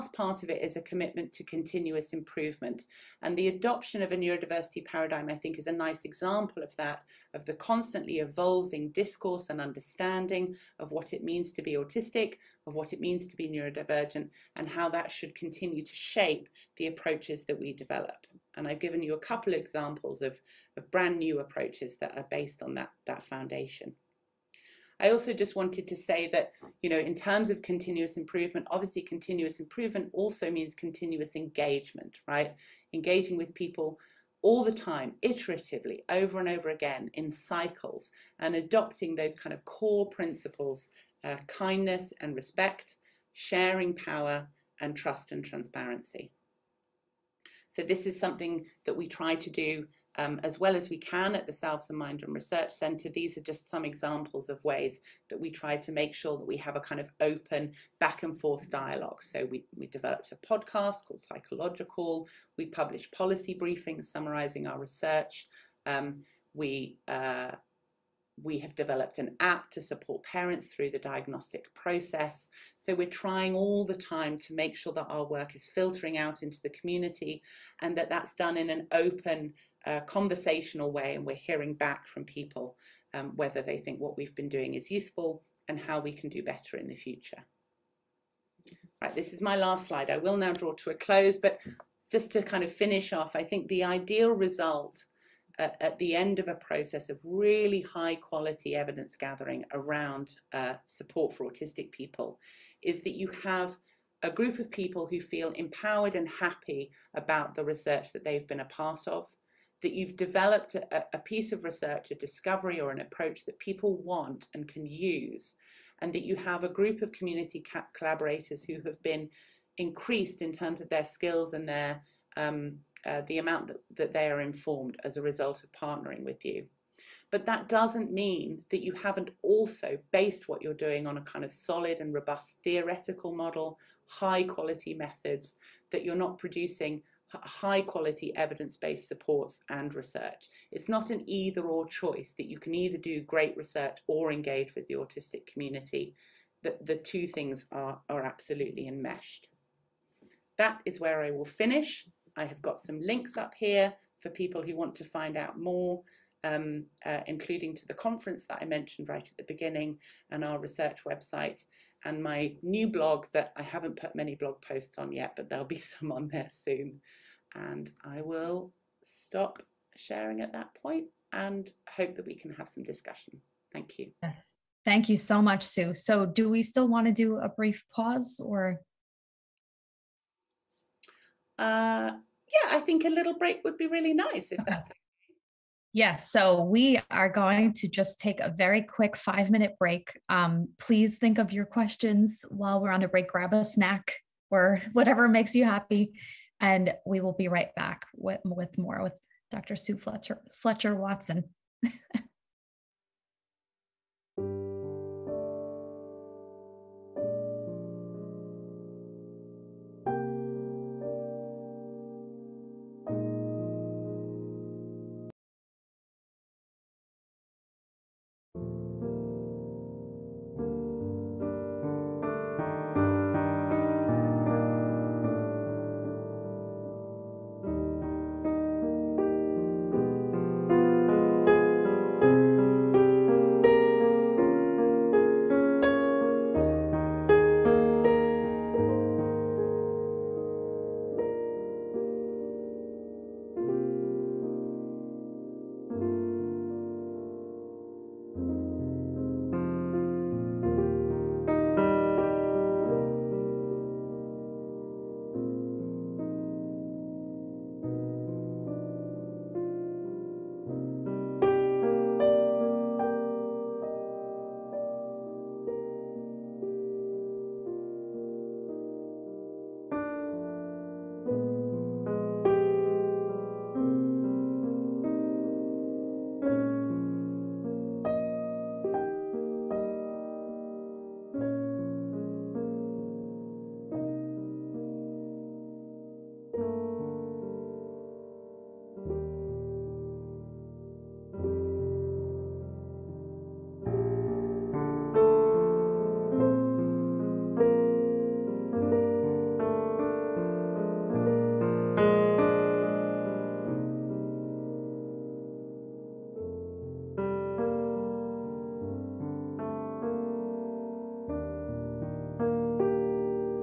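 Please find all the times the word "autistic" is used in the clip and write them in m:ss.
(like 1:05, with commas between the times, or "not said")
0:11, 1:41, 2:24.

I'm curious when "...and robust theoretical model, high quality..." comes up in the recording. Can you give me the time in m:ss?
2:11.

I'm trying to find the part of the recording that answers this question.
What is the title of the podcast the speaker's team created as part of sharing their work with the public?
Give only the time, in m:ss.
1:01.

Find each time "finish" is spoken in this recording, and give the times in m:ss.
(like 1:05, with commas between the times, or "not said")
1:32, 2:31.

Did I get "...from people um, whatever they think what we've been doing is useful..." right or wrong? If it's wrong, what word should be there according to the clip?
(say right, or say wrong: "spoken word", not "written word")
wrong: "whether", not "whatever".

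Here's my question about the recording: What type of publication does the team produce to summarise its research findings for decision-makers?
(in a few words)
policy briefings.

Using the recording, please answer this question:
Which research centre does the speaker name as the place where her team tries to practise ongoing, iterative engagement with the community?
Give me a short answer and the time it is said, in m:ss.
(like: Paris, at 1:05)
Salvesen Mindroom Research Centre, at 0:51.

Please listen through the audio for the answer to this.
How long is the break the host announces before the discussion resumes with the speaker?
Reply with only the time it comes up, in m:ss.
3:09.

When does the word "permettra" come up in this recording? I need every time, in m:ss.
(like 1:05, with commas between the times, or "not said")
not said.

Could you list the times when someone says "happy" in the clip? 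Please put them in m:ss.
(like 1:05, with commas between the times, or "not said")
1:46, 3:15.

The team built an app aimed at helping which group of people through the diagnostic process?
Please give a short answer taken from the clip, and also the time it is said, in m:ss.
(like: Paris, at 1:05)
parents, at 1:10.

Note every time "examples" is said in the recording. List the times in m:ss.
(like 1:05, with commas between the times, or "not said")
0:06, 0:19, 0:53.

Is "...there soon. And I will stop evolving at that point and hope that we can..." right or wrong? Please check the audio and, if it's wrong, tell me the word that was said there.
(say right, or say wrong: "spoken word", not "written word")
wrong: "sharing", not "evolving".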